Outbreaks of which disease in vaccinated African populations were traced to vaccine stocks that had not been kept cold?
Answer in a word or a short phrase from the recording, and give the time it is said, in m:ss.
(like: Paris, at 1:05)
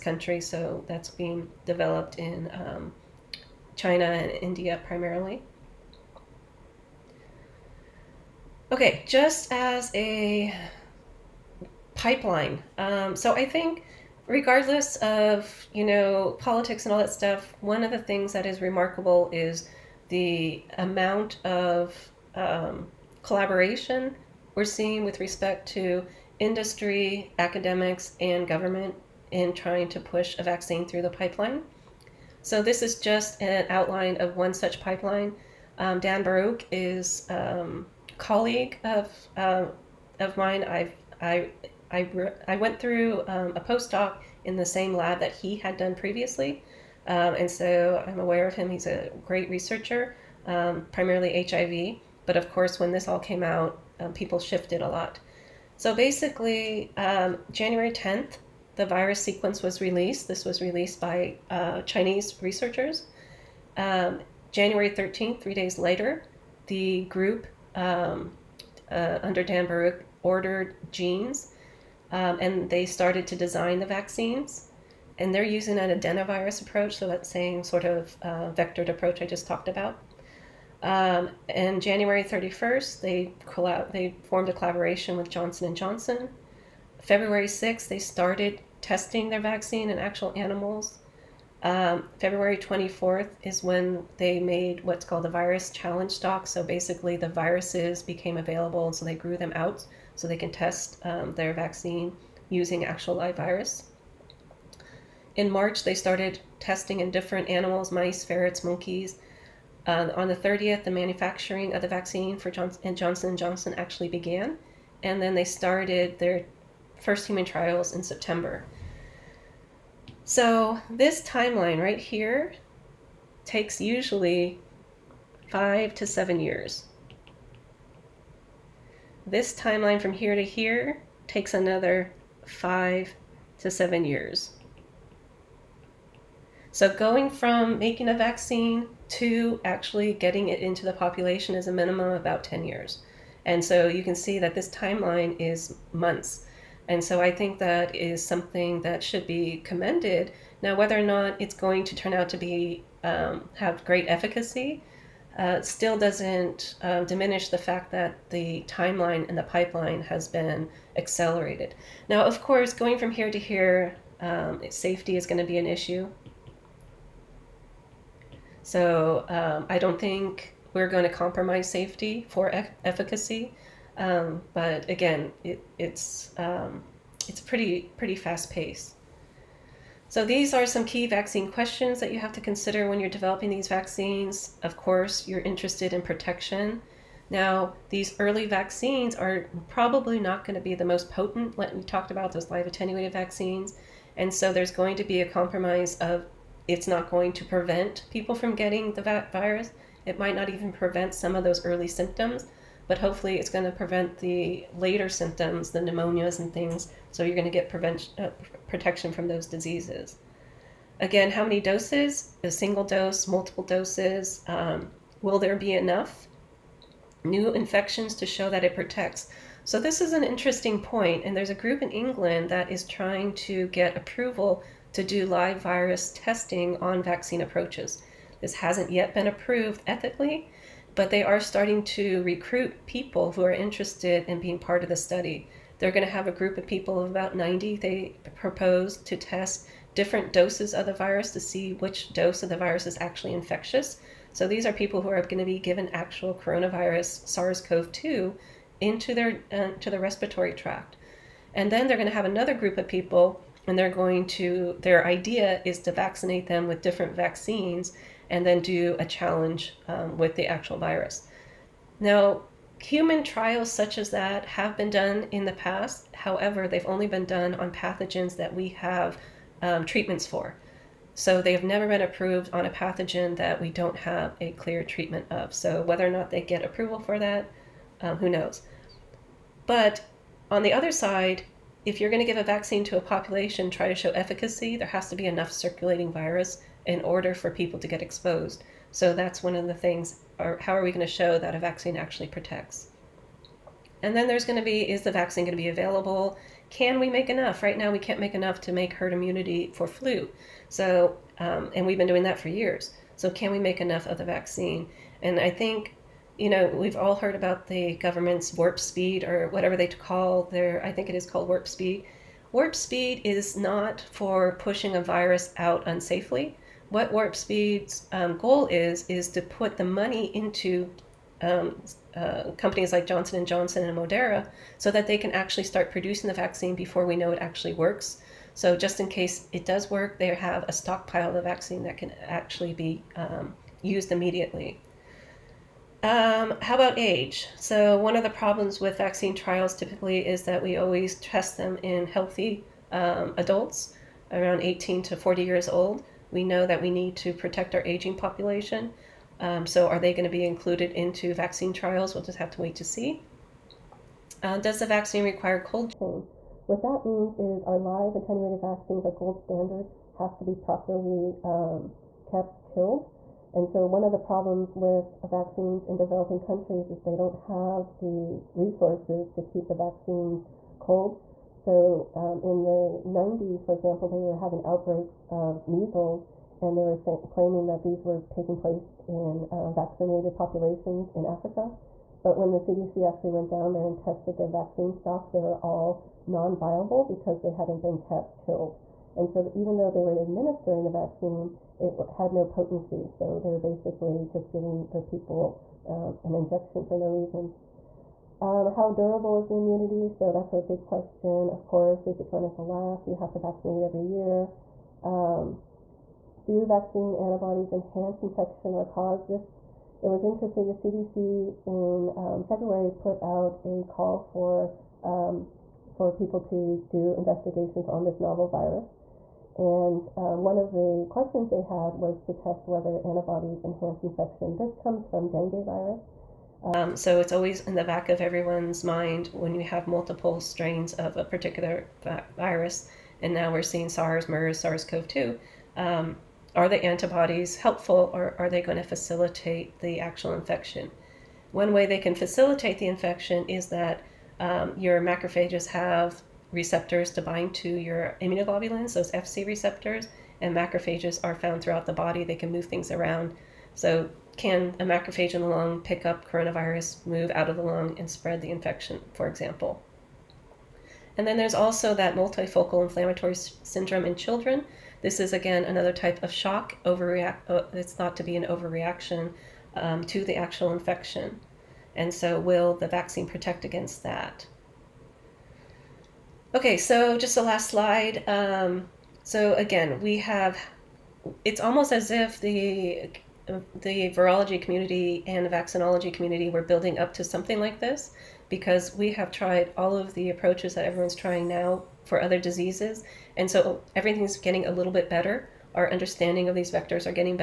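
measles, at 6:15.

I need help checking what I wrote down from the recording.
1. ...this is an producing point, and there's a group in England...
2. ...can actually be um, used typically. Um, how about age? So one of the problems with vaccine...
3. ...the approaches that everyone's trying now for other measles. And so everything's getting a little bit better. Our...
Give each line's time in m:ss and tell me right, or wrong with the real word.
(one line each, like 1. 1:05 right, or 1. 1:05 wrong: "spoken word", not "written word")
1. 3:39 wrong: "interesting", not "producing"
2. 5:31 wrong: "immediately", not "typically"
3. 8:10 wrong: "diseases", not "measles".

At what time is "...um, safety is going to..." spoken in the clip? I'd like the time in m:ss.
2:44.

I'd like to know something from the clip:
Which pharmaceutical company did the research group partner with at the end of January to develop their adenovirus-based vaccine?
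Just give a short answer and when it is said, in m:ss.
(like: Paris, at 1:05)
Johnson & Johnson, at 1:25.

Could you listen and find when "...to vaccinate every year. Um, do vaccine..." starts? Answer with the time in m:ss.
6:43.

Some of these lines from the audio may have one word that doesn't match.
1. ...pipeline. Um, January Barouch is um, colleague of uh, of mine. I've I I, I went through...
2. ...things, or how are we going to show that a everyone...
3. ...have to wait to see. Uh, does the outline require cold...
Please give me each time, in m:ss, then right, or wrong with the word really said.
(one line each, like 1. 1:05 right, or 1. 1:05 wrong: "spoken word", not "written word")
1. 0:34 wrong: "Dan", not "January"
2. 4:49 wrong: "vaccine", not "everyone"
3. 5:52 wrong: "vaccine", not "outline".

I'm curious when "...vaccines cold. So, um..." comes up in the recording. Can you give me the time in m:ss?
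6:09.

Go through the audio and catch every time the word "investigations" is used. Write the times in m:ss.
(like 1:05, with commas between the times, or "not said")
6:57.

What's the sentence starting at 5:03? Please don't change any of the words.
So, can we make enough of the vaccine?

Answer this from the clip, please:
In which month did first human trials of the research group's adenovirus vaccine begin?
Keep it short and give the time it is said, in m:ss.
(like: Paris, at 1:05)
September, at 1:58.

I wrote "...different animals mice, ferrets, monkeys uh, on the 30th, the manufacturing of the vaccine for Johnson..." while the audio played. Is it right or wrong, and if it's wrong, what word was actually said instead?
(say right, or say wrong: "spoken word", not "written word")
right.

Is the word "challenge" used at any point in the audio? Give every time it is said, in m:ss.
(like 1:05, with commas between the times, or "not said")
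1:35, 4:19.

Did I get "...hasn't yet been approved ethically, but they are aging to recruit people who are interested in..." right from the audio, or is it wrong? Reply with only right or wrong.
wrong.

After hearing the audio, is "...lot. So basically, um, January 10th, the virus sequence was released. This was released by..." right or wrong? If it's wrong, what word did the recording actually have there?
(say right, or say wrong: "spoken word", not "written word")
right.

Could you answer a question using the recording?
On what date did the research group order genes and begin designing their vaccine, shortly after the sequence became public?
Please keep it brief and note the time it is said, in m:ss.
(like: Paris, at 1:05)
January 13, at 1:04.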